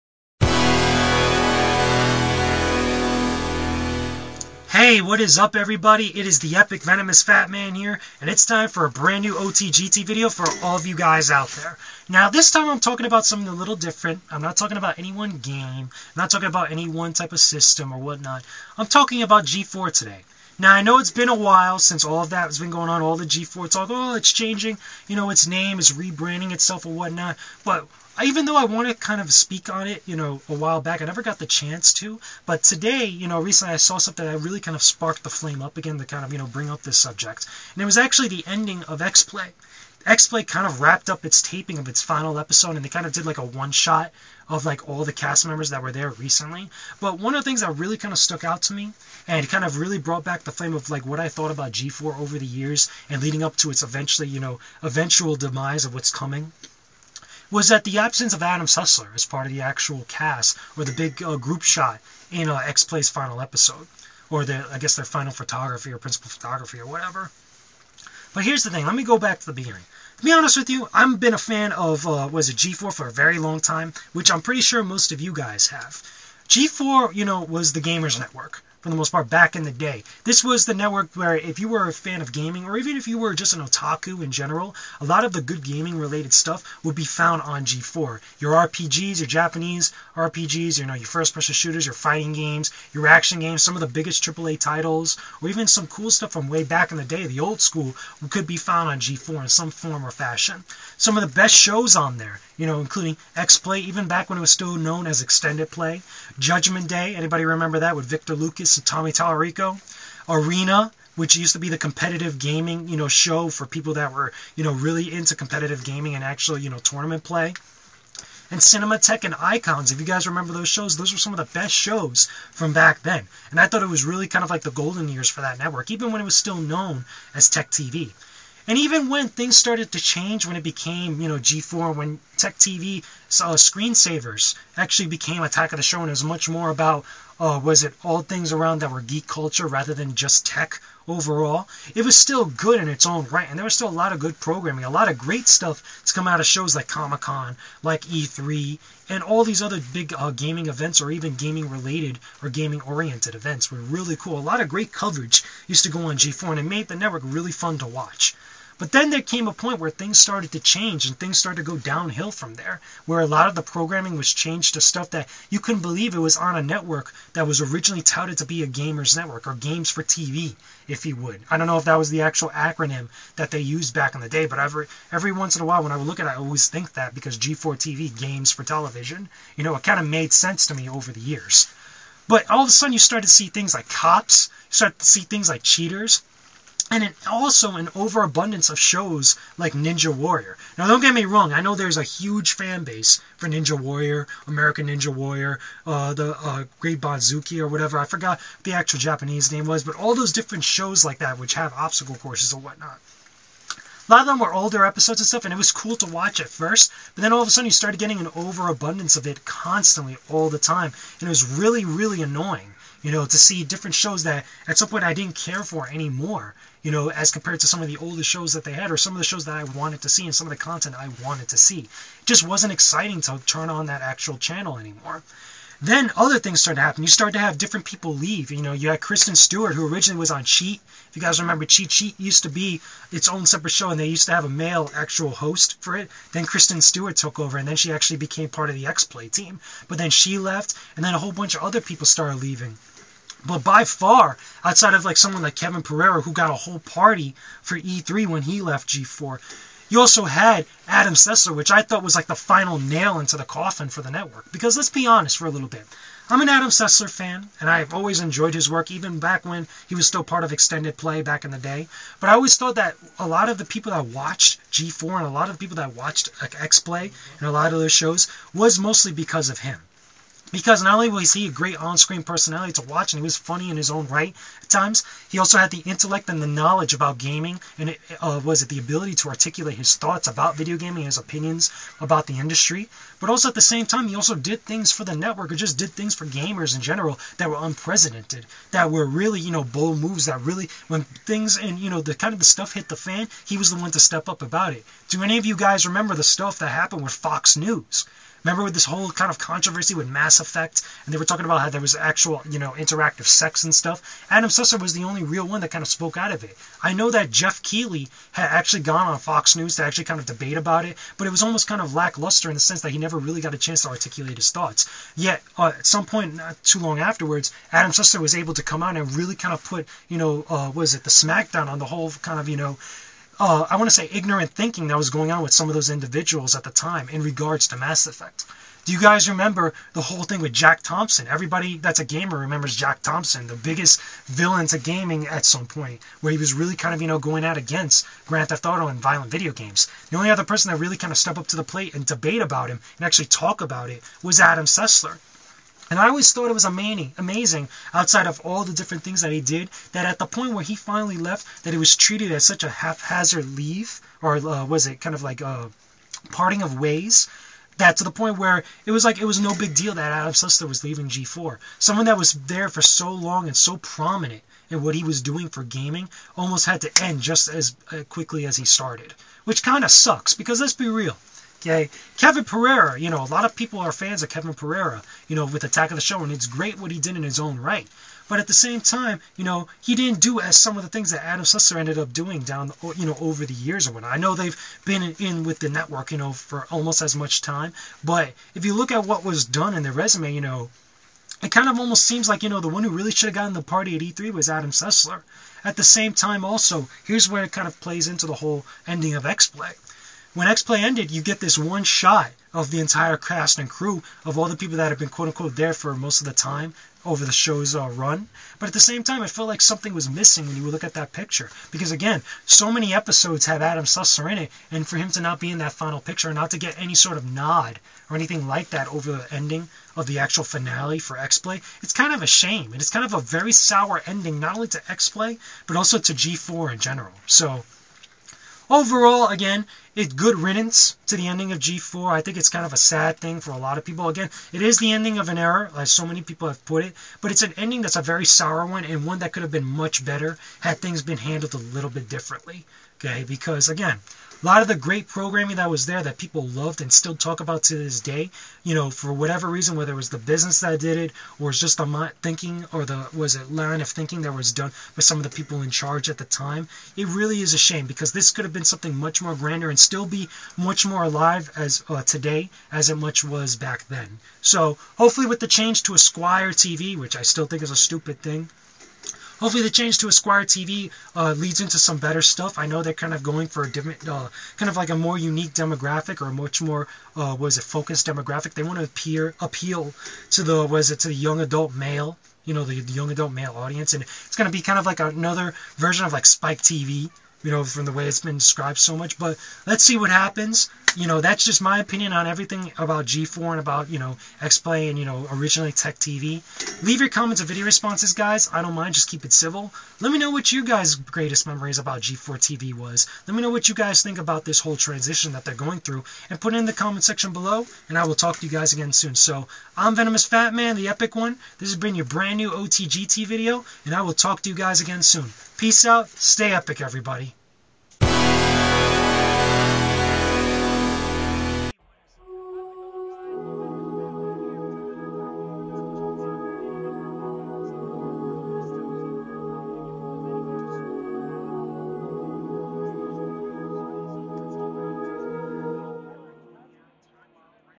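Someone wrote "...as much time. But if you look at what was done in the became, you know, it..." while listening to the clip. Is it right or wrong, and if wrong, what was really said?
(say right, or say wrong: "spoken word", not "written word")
wrong: "resume", not "became".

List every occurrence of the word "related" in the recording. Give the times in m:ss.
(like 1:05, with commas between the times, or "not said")
1:25, 2:31.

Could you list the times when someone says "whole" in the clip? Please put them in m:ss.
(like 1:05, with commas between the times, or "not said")
4:01, 4:06, 4:58, 5:21, 5:30, 6:38, 8:24.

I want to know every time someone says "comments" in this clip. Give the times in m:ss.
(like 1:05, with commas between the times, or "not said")
8:17, 8:26.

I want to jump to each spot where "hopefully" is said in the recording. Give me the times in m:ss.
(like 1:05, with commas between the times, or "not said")
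7:44, 7:49.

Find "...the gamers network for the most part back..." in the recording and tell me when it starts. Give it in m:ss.
1:17.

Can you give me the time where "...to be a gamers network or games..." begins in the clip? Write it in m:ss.
2:48.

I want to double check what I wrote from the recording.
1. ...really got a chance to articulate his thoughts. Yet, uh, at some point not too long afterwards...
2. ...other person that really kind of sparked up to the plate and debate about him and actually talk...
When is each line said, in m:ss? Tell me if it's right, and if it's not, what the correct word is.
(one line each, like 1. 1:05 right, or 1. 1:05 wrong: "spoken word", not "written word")
1. 5:13 right
2. 5:40 wrong: "stepped", not "sparked".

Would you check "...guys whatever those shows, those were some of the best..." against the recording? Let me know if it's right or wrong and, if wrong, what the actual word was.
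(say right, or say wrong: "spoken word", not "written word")
wrong: "remember", not "whatever".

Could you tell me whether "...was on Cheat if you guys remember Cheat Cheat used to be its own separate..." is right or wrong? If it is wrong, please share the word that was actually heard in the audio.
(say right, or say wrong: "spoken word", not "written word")
right.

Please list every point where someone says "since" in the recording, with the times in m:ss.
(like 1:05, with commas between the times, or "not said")
0:21.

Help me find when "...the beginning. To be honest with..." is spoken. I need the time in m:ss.
1:09.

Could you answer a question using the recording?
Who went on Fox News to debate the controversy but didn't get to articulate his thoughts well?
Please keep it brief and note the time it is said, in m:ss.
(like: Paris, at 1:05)
Geoff Keighley, at 5:07.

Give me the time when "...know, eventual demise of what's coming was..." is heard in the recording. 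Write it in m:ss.
0:54.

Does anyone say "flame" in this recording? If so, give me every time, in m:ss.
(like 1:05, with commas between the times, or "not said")
0:35, 0:50.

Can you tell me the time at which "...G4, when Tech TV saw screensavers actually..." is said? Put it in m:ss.
2:11.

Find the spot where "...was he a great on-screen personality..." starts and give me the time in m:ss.
4:31.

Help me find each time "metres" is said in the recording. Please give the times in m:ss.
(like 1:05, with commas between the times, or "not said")
not said.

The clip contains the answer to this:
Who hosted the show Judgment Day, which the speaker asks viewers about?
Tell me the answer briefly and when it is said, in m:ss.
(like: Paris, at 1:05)
Victor Lucas, at 1:48.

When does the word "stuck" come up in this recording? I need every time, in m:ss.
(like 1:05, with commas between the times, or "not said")
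0:48.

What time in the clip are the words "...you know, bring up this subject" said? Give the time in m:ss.
0:36.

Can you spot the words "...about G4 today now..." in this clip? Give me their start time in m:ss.
0:19.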